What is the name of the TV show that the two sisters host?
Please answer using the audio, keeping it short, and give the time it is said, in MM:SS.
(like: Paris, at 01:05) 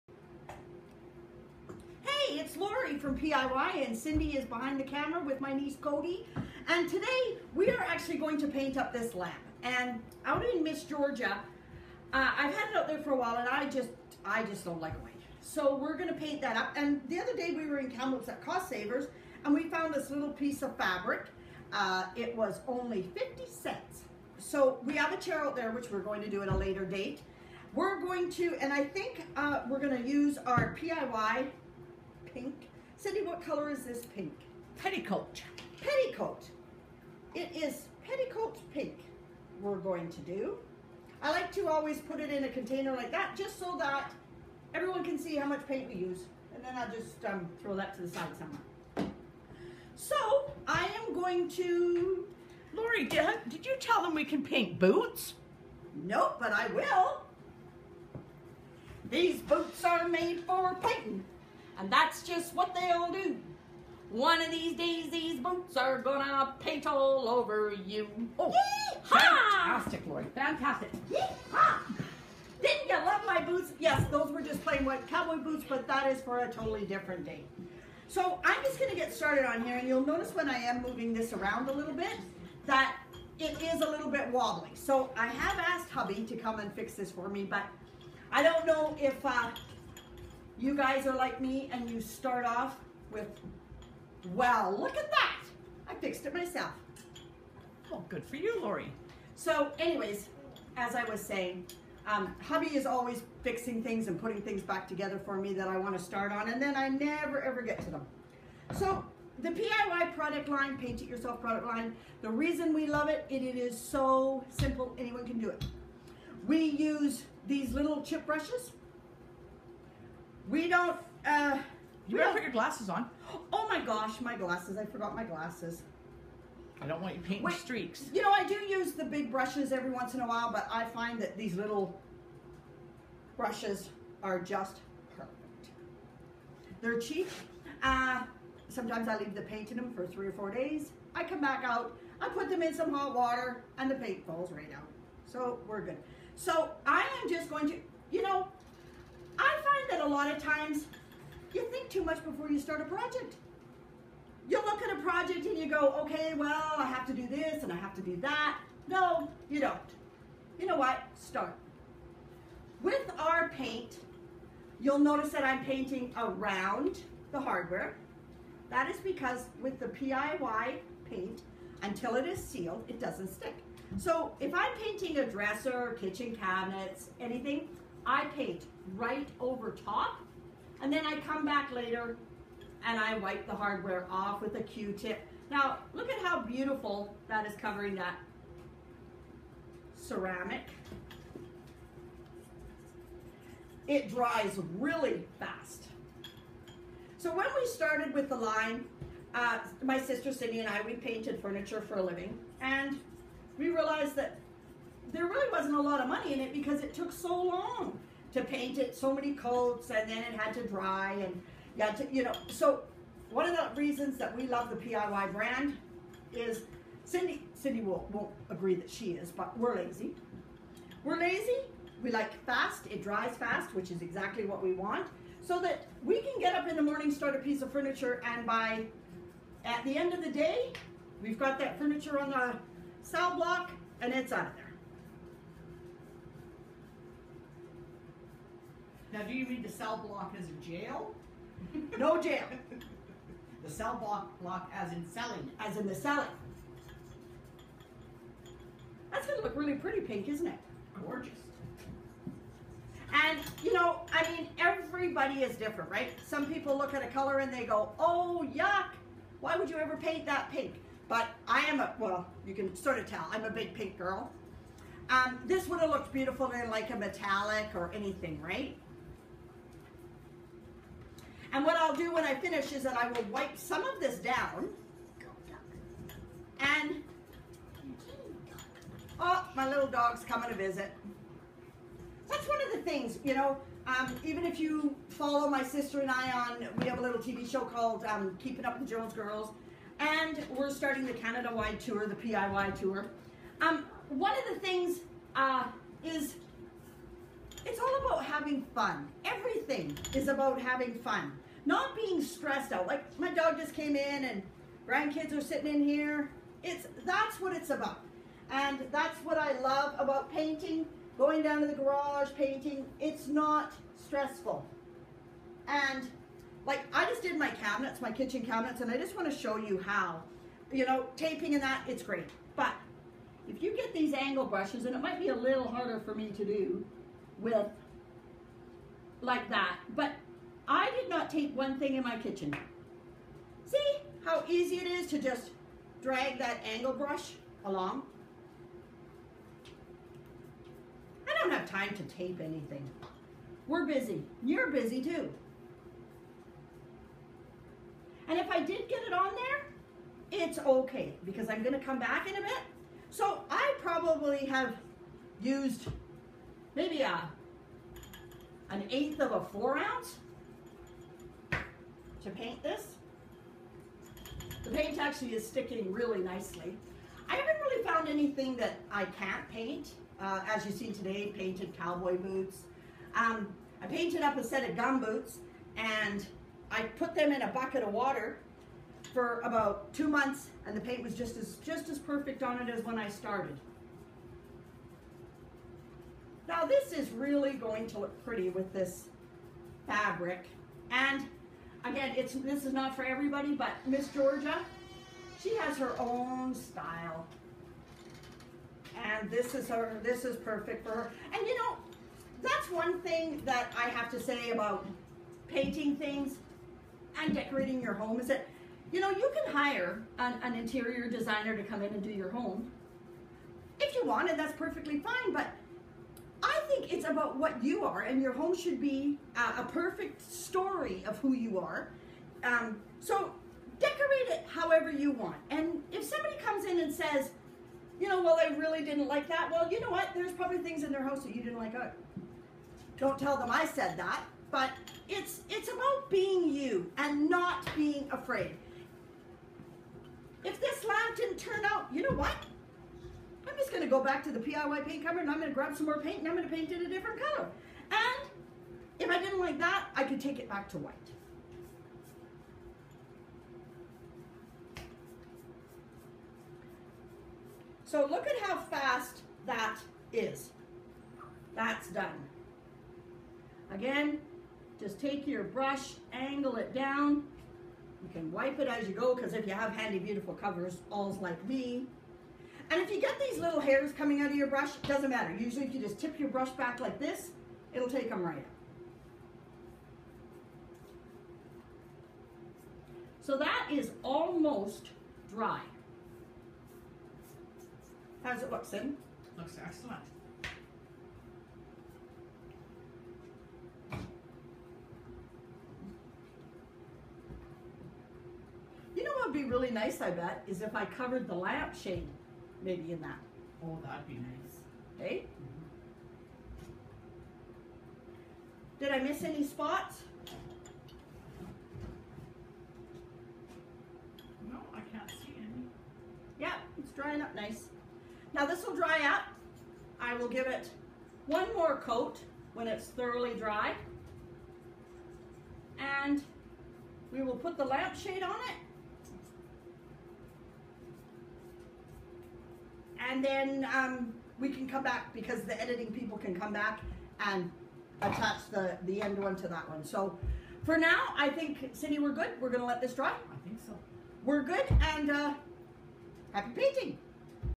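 Keeping Up with the Jones Girls, at 04:48.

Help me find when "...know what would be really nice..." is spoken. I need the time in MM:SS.
08:19.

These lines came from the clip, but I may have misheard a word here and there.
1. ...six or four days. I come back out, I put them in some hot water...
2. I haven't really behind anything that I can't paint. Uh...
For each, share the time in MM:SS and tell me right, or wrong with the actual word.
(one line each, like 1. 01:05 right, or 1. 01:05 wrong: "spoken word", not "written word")
1. 02:20 wrong: "three", not "six"
2. 06:07 wrong: "found", not "behind".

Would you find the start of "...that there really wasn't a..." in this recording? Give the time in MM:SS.
03:24.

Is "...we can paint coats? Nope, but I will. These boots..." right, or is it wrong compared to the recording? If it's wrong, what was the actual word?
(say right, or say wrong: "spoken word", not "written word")
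wrong: "boots", not "coats".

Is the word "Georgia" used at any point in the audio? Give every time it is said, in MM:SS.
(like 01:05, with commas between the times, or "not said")
00:10, 06:34.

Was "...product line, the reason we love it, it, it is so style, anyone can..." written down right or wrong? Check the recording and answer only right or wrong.
wrong.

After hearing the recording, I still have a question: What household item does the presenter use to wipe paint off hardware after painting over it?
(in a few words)
Q-tip.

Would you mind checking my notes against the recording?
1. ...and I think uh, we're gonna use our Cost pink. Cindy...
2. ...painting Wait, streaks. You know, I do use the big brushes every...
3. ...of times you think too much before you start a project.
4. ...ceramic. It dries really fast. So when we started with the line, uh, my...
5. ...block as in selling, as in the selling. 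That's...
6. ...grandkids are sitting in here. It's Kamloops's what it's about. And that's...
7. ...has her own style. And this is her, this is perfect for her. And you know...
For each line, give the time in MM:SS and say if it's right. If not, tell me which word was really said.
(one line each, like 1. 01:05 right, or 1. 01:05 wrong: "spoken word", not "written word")
1. 00:28 wrong: "PIY", not "Cost"
2. 02:07 right
3. 02:30 right
4. 03:09 right
5. 04:04 right
6. 05:04 wrong: "That", not "Kamloops"
7. 06:35 right.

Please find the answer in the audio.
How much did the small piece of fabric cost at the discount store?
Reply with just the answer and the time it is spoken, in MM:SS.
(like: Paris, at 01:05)
50 cents, at 00:23.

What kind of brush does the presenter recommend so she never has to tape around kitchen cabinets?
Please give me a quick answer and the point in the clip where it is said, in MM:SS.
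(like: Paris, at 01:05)
angle brushes, at 05:24.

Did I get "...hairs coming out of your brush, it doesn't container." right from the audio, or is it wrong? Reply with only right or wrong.
wrong.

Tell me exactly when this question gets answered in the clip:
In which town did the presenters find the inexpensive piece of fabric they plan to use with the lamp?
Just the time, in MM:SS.
00:17.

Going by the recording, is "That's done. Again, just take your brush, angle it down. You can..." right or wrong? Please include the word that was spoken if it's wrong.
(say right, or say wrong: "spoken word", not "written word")
right.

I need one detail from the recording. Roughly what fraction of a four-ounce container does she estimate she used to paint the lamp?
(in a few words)
an eighth.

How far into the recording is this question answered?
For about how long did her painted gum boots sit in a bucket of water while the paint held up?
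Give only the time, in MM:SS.
06:19.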